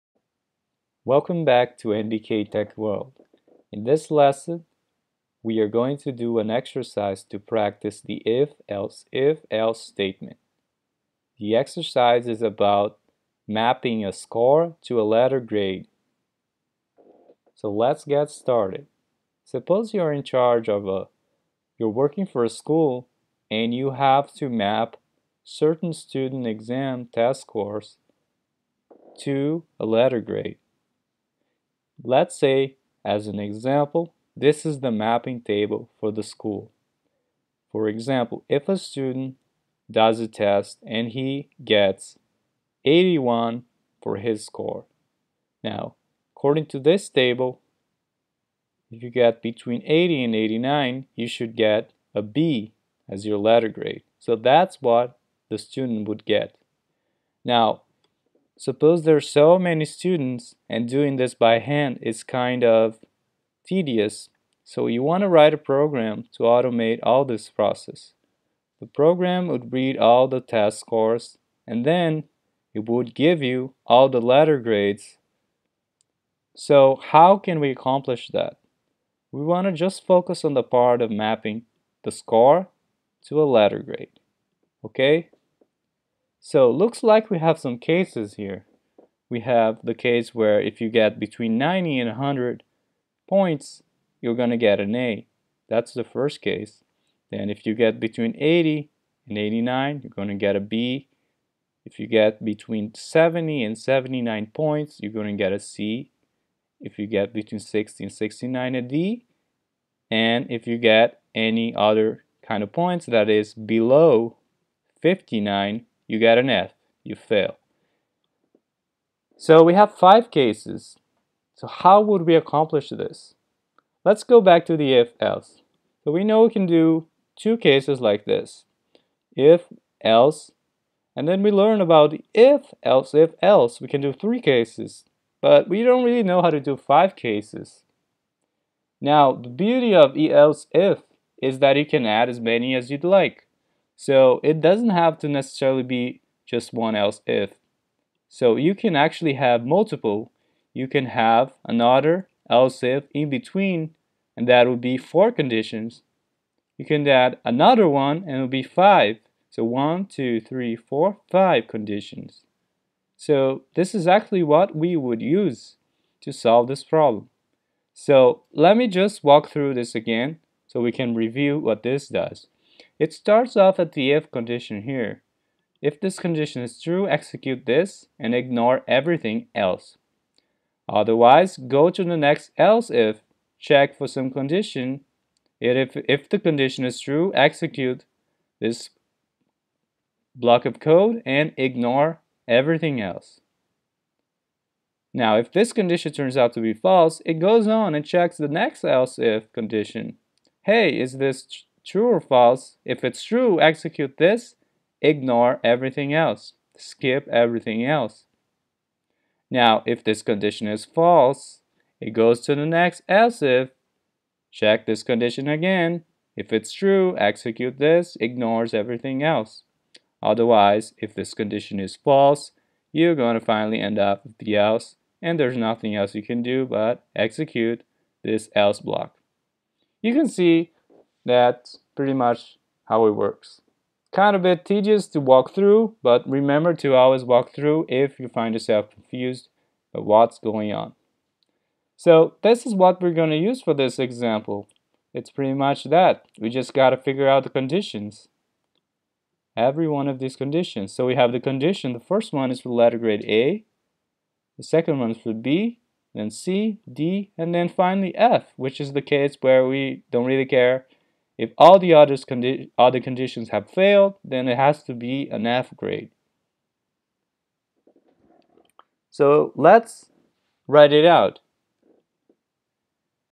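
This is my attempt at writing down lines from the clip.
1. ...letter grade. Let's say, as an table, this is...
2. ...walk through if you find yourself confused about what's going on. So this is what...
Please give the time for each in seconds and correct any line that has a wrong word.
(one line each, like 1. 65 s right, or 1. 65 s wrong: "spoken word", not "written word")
1. 29 s wrong: "example", not "table"
2. 237 s right.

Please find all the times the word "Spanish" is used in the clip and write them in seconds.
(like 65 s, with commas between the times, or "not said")
not said.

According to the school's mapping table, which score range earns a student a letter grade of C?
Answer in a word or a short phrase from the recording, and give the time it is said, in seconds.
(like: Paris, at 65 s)
70 to 79, at 102 s.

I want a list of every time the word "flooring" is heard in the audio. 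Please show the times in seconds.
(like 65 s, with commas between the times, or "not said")
not said.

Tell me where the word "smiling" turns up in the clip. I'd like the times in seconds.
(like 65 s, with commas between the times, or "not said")
not said.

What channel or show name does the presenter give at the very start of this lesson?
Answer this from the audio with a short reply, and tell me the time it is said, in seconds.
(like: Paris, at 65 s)
NBK Tech World, at 1 s.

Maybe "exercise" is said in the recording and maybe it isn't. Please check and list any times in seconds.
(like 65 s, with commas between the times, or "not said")
6 s, 11 s.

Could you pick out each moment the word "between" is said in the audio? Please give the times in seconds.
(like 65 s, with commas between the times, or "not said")
49 s, 91 s, 97 s, 102 s, 107 s, 153 s.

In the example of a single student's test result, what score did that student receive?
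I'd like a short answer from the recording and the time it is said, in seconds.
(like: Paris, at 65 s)
81, at 42 s.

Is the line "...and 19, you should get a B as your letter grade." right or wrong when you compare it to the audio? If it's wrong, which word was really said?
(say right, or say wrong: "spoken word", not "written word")
wrong: "89", not "19".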